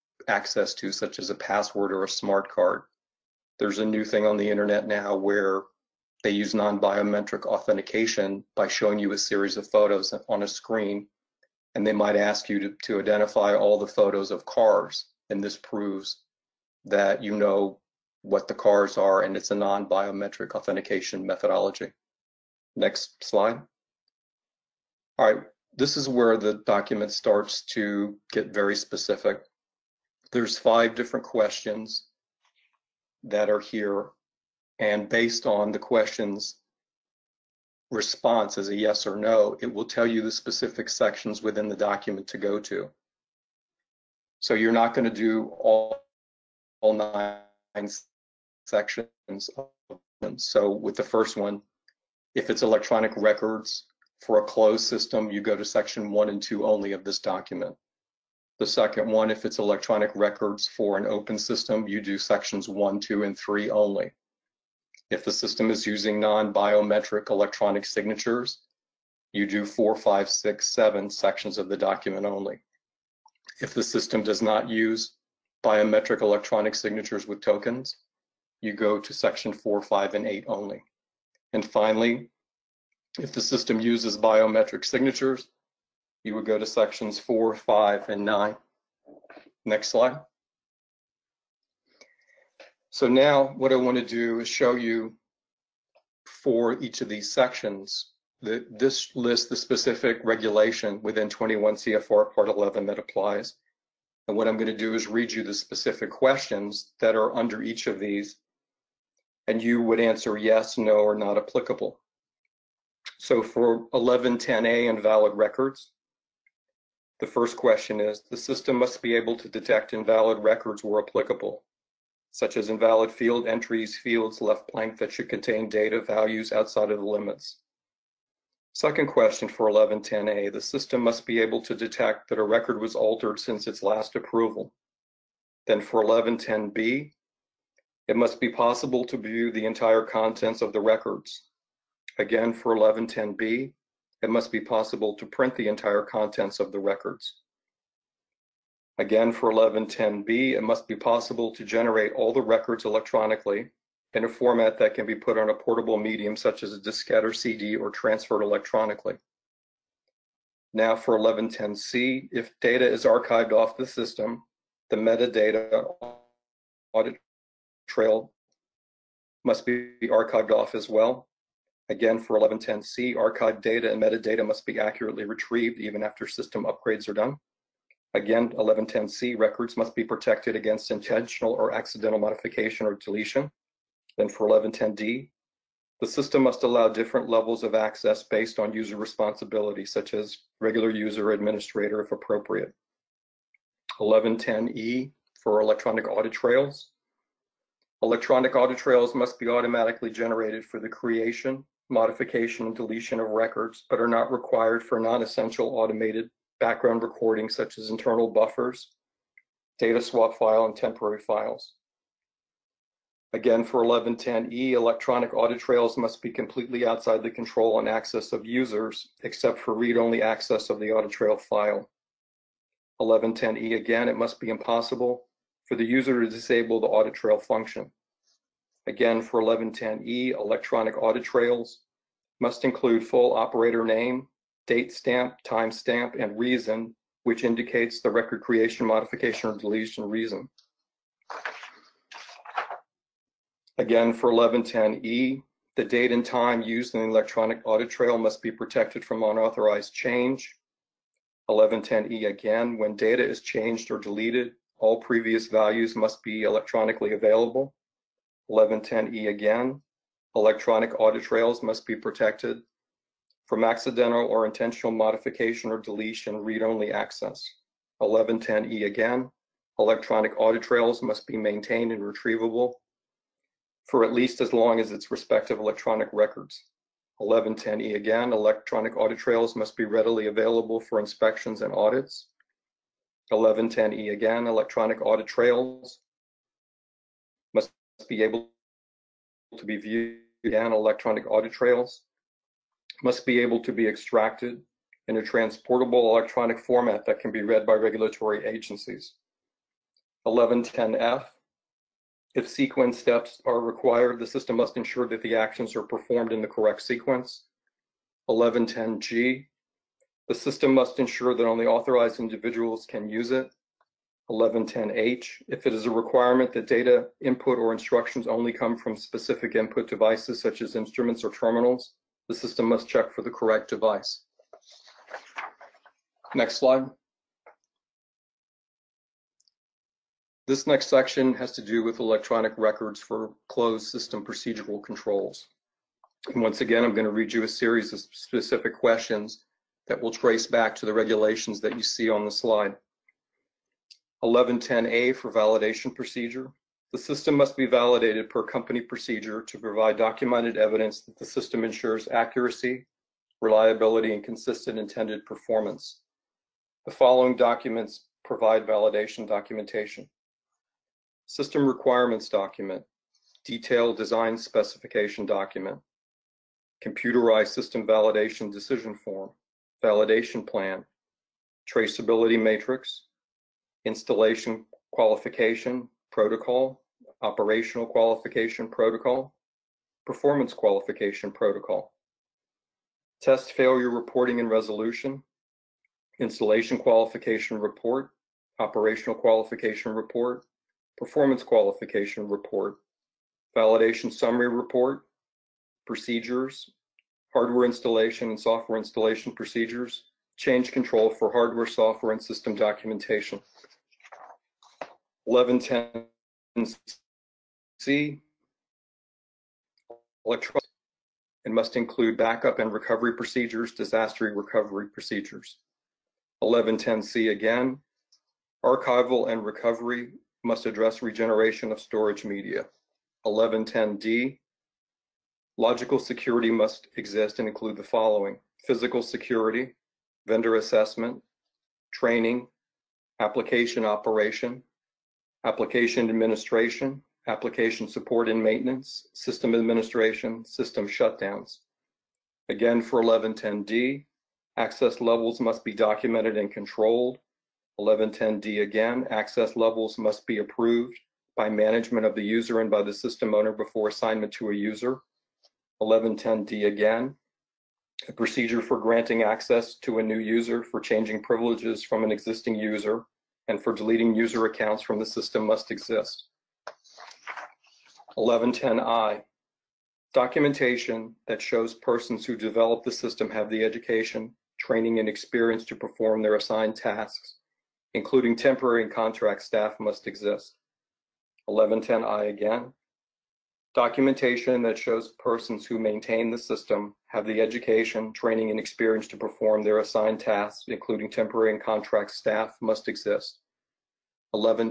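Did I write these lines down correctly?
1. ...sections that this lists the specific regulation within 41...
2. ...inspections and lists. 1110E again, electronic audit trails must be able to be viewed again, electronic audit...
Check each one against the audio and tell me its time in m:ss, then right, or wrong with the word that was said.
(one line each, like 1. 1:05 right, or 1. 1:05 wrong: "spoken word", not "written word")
1. 1:37 wrong: "21", not "41"
2. 4:40 wrong: "audits", not "lists".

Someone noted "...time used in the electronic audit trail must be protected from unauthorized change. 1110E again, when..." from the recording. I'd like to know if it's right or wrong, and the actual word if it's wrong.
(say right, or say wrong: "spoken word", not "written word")
right.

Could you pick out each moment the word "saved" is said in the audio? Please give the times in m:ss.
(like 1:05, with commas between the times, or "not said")
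not said.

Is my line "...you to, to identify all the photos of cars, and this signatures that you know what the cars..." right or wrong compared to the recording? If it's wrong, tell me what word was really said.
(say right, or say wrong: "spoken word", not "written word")
wrong: "proves", not "signatures".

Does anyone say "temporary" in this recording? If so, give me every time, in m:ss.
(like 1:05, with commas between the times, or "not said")
3:30, 7:58, 8:11.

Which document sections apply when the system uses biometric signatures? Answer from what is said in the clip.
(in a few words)
Sections 4, 5, and 9.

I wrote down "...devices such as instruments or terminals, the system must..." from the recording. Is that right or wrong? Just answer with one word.
right.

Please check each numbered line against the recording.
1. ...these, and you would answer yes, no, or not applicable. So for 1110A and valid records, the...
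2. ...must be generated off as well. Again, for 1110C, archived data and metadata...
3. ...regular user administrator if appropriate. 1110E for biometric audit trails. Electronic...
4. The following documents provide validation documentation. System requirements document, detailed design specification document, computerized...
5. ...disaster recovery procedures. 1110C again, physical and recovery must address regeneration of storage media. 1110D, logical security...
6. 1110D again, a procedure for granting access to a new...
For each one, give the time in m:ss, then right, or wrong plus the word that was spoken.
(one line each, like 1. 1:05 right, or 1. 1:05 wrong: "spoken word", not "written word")
1. 1:47 right
2. 2:49 wrong: "archived", not "generated"
3. 3:10 wrong: "electronic", not "biometric"
4. 5:56 right
5. 6:53 wrong: "archival", not "physical"
6. 7:35 right.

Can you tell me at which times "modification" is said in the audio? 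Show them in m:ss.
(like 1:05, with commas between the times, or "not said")
3:02, 3:21, 3:58, 4:24.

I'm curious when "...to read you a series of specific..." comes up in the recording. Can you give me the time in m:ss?
5:37.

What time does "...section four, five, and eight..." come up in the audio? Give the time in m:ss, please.
1:19.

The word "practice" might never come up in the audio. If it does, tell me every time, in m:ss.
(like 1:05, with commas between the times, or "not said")
not said.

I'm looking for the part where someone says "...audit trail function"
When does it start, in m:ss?
3:46.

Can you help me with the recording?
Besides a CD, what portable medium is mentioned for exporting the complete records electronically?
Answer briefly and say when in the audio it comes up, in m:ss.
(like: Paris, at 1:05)
Diskette, at 2:36.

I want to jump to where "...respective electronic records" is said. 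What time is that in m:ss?
4:35.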